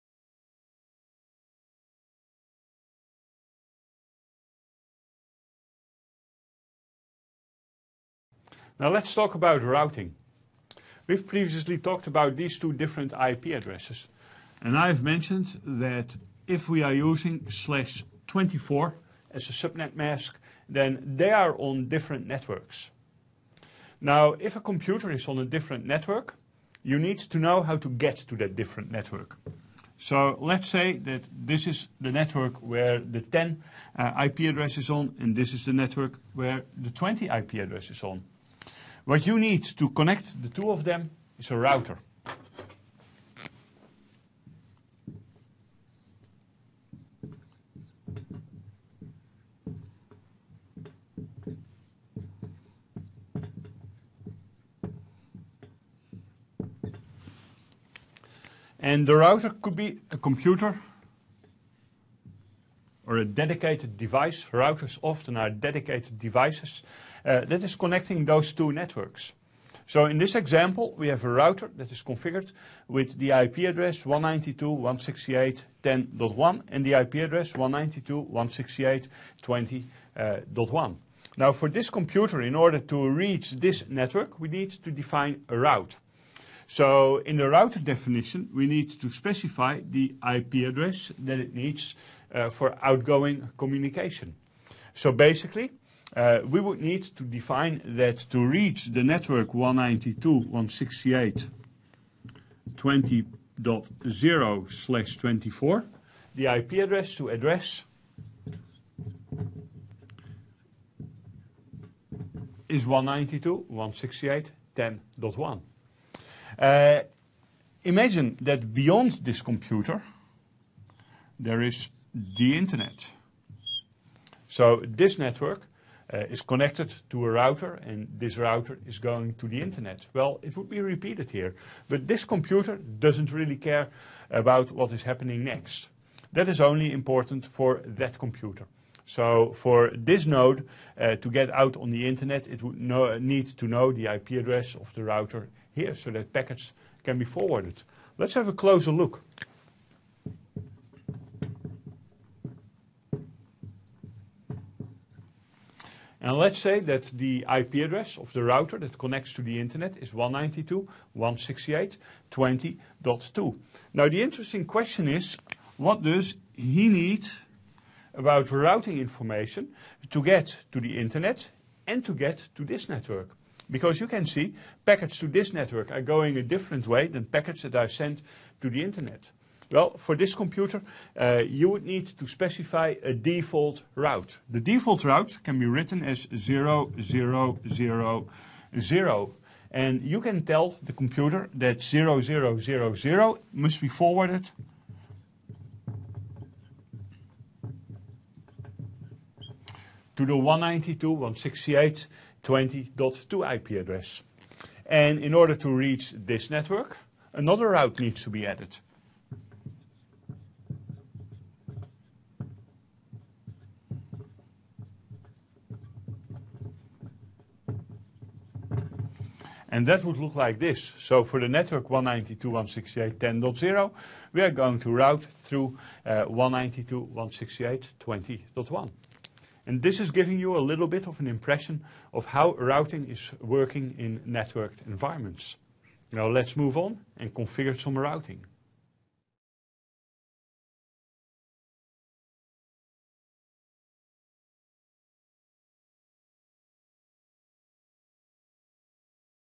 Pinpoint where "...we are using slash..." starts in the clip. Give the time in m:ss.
0:16.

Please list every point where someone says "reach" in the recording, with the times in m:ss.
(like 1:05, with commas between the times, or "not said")
1:23, 1:38, 3:25.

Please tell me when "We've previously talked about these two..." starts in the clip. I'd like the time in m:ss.
0:11.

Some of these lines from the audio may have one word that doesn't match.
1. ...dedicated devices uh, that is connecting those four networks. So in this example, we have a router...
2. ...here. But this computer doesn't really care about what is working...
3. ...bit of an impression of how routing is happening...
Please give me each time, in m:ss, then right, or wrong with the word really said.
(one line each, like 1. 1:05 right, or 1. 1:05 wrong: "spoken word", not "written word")
1. 1:05 wrong: "two", not "four"
2. 2:11 wrong: "happening", not "working"
3. 3:50 wrong: "working", not "happening".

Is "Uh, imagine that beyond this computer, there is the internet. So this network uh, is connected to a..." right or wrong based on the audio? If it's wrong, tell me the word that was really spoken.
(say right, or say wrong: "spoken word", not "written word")
right.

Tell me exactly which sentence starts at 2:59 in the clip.
Well, for this computer, uh, you would need to specify a default route.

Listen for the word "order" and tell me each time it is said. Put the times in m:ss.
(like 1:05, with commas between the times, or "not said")
1:22, 3:25.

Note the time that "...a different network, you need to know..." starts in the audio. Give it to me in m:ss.
0:25.